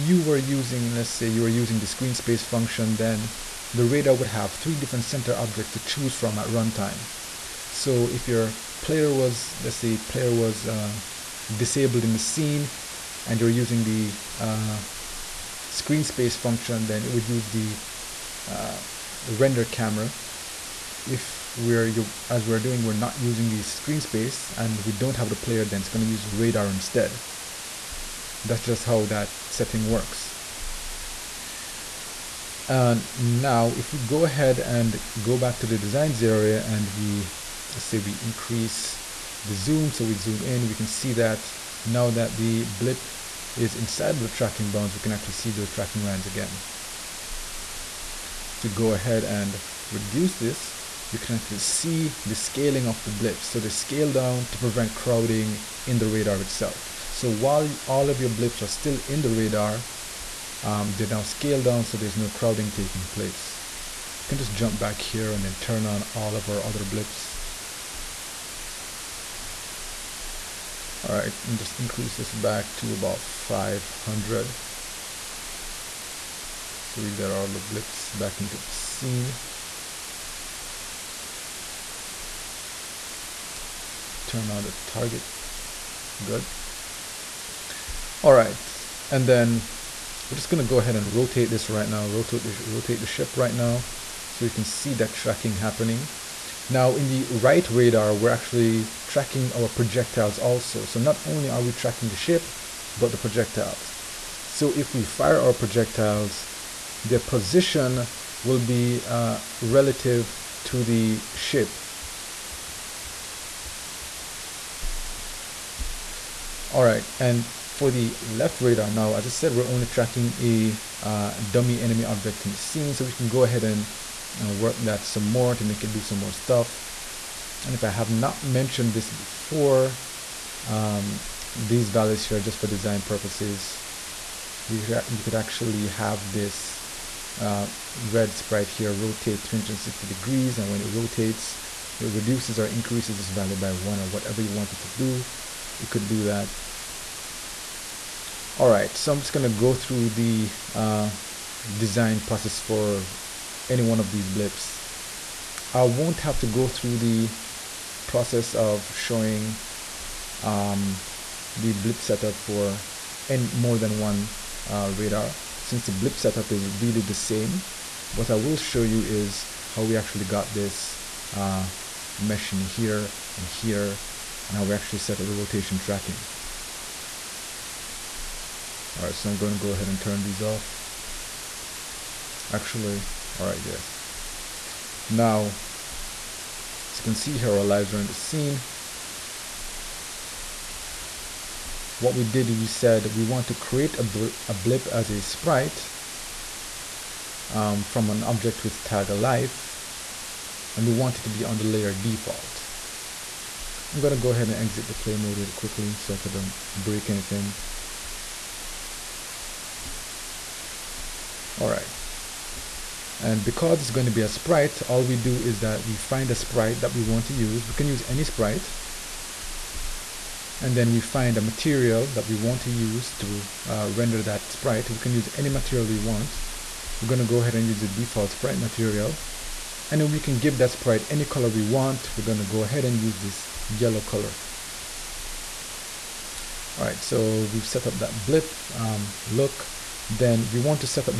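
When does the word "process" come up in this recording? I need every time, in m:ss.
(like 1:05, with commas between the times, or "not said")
2:32, 2:38.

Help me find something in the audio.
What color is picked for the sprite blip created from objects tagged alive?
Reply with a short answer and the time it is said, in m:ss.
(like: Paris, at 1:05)
yellow, at 3:53.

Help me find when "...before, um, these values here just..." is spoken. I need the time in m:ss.
2:09.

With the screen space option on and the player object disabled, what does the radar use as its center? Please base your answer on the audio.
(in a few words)
render camera.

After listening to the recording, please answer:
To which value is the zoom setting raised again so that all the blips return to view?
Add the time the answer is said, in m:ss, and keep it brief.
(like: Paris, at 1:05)
500, at 1:13.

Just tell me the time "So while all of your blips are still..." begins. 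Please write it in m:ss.
0:57.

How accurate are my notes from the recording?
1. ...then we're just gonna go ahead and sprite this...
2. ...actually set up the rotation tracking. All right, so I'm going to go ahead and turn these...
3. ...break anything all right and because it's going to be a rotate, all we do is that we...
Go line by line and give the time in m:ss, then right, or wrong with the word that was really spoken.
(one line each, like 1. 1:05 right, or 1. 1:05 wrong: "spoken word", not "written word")
1. 1:29 wrong: "rotate", not "sprite"
2. 2:54 right
3. 3:26 wrong: "sprite", not "rotate".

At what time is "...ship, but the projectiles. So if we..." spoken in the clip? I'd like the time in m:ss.
1:42.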